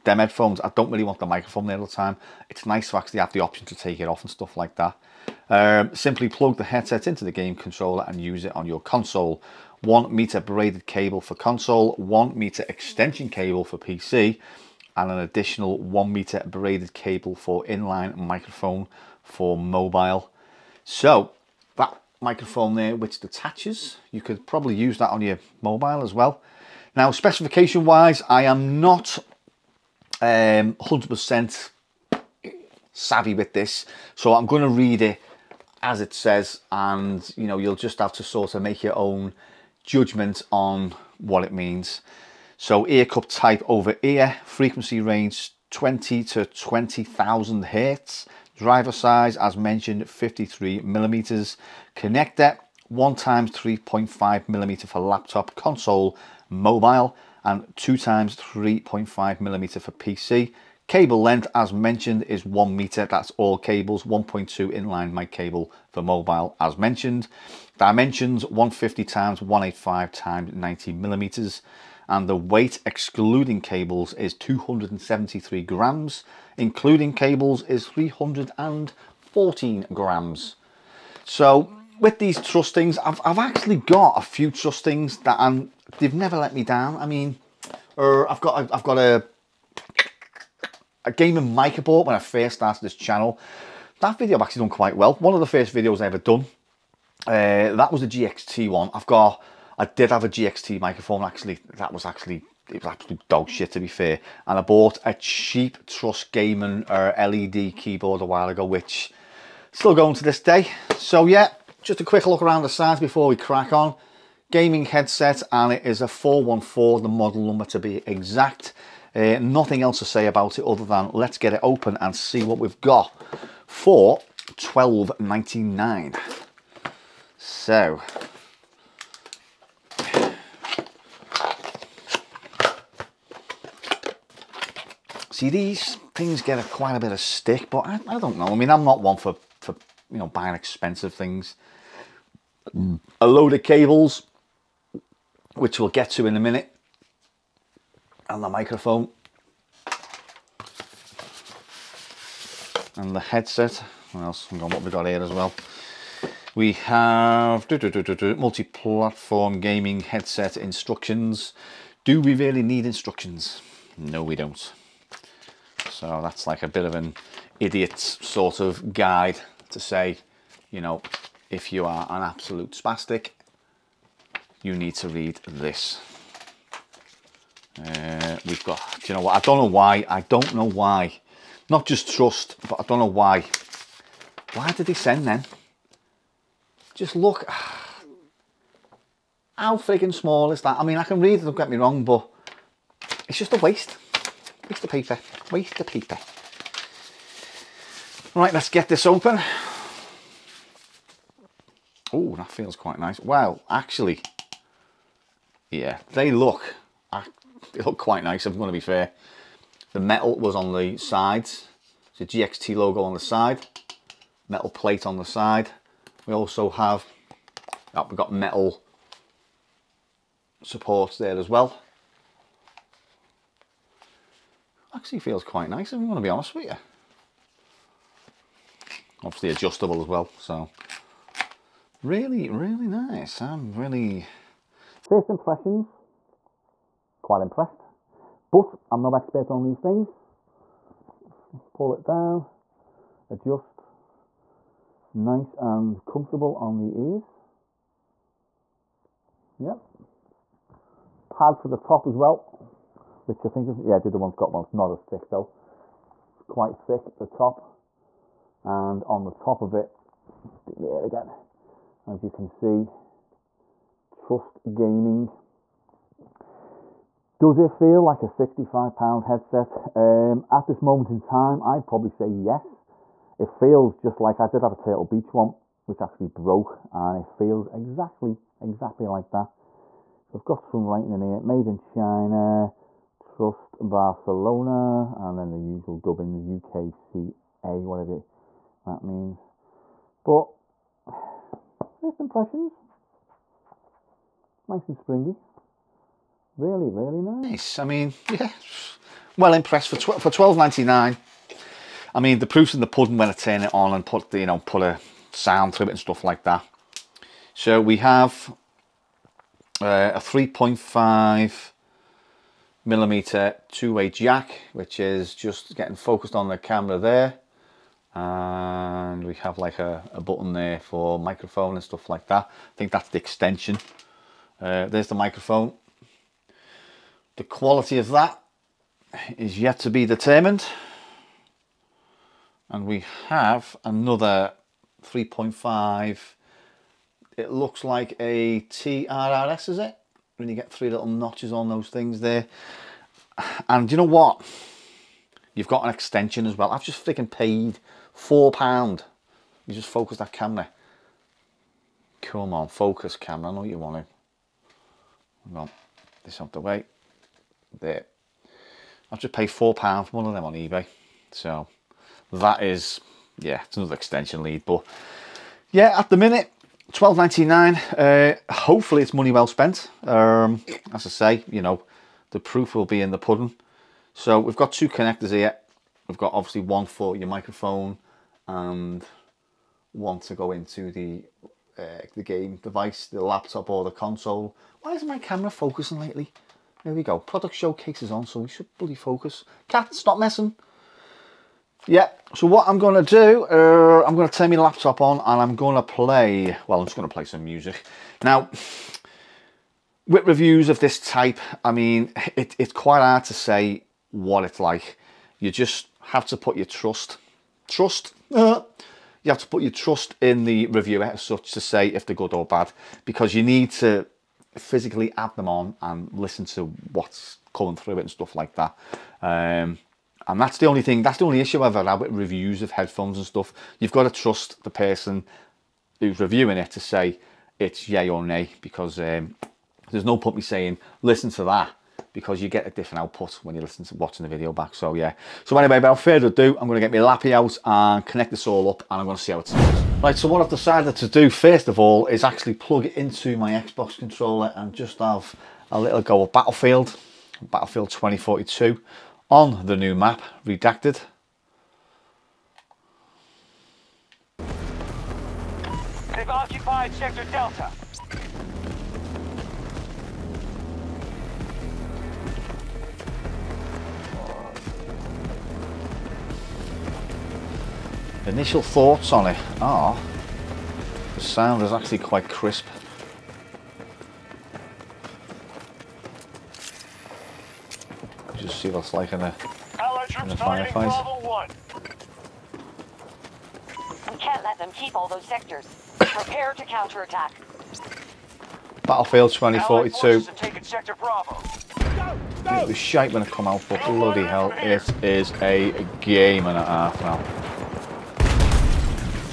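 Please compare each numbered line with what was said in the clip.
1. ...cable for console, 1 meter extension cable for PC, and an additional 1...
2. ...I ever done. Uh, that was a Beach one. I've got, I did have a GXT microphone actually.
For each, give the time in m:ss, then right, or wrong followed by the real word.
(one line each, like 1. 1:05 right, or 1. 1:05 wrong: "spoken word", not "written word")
1. 0:10 right
2. 1:35 wrong: "GXT", not "Beach".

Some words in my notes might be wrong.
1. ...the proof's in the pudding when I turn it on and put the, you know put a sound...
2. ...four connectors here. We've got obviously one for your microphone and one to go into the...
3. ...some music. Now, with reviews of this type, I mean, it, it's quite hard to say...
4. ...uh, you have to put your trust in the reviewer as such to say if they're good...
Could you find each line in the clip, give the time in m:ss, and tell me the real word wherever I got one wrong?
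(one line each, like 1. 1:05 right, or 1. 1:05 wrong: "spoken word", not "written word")
1. 5:02 right
2. 6:14 wrong: "two", not "four"
3. 6:37 right
4. 6:48 right.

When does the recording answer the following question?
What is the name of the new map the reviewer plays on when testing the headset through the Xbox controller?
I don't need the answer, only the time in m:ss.
7:30.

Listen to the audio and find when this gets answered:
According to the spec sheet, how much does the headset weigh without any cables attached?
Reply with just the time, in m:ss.
1:14.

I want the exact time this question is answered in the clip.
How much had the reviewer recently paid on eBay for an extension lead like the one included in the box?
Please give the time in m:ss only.
5:59.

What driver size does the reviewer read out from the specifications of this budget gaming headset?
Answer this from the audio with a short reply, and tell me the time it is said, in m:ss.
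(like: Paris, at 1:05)
53 millimeters, at 0:50.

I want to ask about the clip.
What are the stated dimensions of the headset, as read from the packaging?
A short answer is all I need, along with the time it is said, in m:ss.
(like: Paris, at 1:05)
150 x 185 x 90 mm, at 1:08.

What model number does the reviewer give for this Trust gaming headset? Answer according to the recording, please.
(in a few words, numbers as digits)
414.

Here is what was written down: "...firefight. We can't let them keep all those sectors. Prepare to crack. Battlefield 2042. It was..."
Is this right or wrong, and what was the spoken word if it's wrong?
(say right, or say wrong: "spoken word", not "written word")
wrong: "counterattack", not "crack".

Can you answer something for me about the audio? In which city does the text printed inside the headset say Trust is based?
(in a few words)
Barcelona.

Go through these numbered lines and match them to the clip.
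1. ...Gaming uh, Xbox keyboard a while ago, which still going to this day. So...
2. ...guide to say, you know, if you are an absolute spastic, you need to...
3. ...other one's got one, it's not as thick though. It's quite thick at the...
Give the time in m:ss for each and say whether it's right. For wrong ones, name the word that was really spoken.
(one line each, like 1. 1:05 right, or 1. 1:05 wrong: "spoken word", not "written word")
1. 1:46 wrong: "LED", not "Xbox"
2. 2:48 right
3. 4:14 right.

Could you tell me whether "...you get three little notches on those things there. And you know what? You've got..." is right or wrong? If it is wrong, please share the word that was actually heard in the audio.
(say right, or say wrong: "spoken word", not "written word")
right.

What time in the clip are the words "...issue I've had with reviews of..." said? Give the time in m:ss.
7:01.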